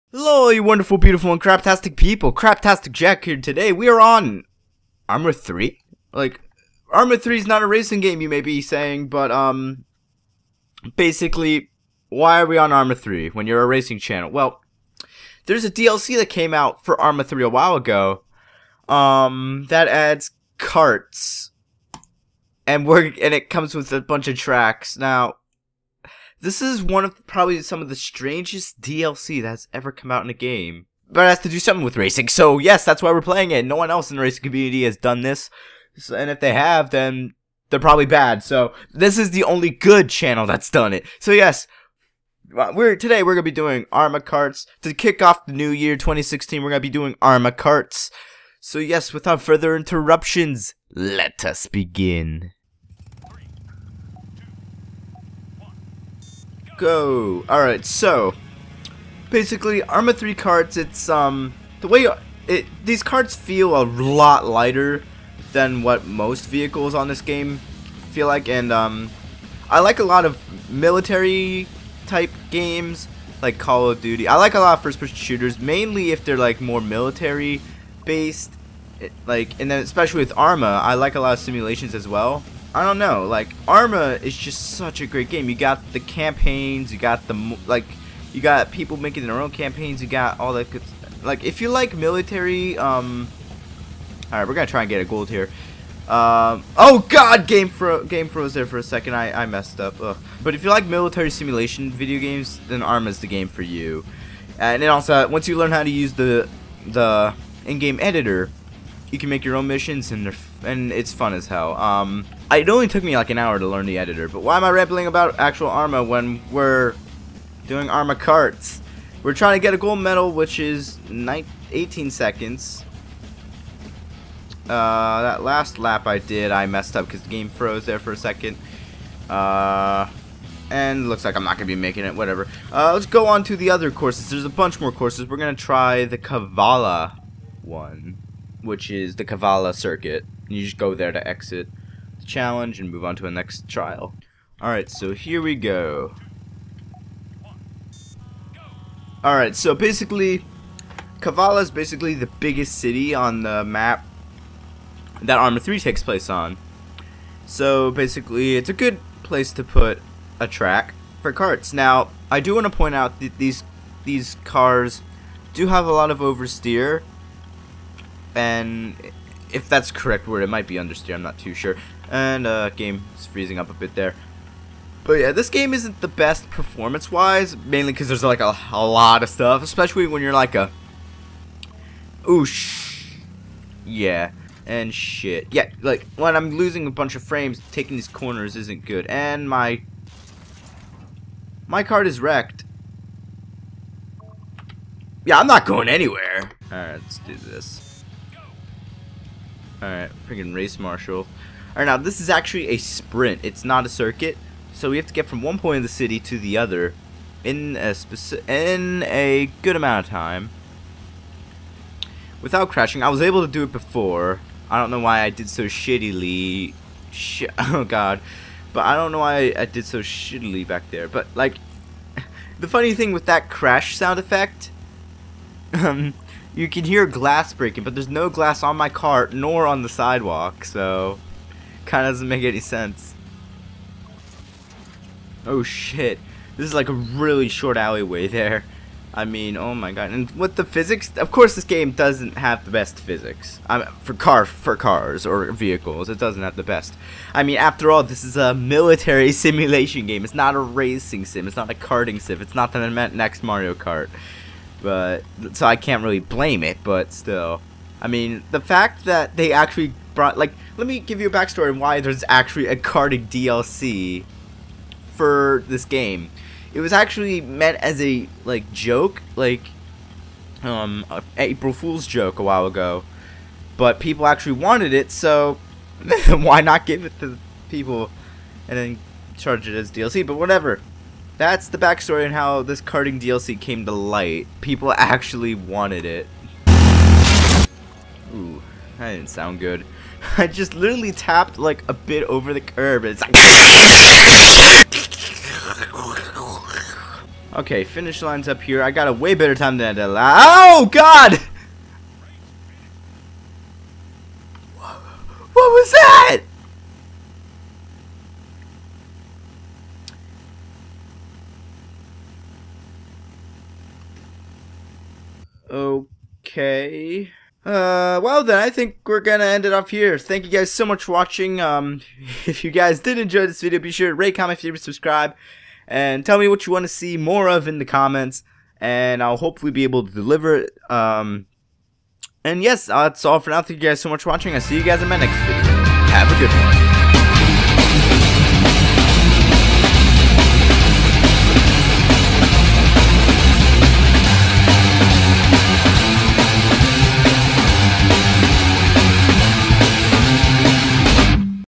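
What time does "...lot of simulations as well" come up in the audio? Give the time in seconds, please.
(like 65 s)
81 s.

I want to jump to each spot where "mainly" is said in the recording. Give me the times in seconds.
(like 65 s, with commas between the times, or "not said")
75 s, 177 s.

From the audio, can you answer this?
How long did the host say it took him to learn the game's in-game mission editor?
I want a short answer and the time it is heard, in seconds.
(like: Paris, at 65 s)
an hour, at 113 s.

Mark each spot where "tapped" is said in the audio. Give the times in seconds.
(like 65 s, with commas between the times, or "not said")
291 s.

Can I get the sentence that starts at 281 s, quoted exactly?
That's the backstory and how this karting DLC came to light.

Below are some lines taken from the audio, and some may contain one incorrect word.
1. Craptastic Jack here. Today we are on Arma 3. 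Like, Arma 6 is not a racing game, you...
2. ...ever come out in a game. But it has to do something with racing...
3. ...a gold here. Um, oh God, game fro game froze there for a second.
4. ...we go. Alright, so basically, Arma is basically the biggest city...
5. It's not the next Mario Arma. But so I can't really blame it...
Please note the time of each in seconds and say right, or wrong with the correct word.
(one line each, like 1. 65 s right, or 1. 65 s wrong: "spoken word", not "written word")
1. 2 s wrong: "3", not "6"
2. 29 s right
3. 95 s right
4. 145 s wrong: "Kavala", not "Arma"
5. 252 s wrong: "Kart", not "Arma".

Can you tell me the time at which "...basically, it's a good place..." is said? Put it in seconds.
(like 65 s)
157 s.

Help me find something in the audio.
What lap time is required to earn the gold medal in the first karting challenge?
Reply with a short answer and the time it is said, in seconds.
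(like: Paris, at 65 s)
18 seconds, at 121 s.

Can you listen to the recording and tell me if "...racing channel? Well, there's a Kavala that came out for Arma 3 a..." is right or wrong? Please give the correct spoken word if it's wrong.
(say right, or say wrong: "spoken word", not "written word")
wrong: "DLC", not "Kavala".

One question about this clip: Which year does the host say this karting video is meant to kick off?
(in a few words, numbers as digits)
2016.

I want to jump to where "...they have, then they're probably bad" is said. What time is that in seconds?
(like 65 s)
36 s.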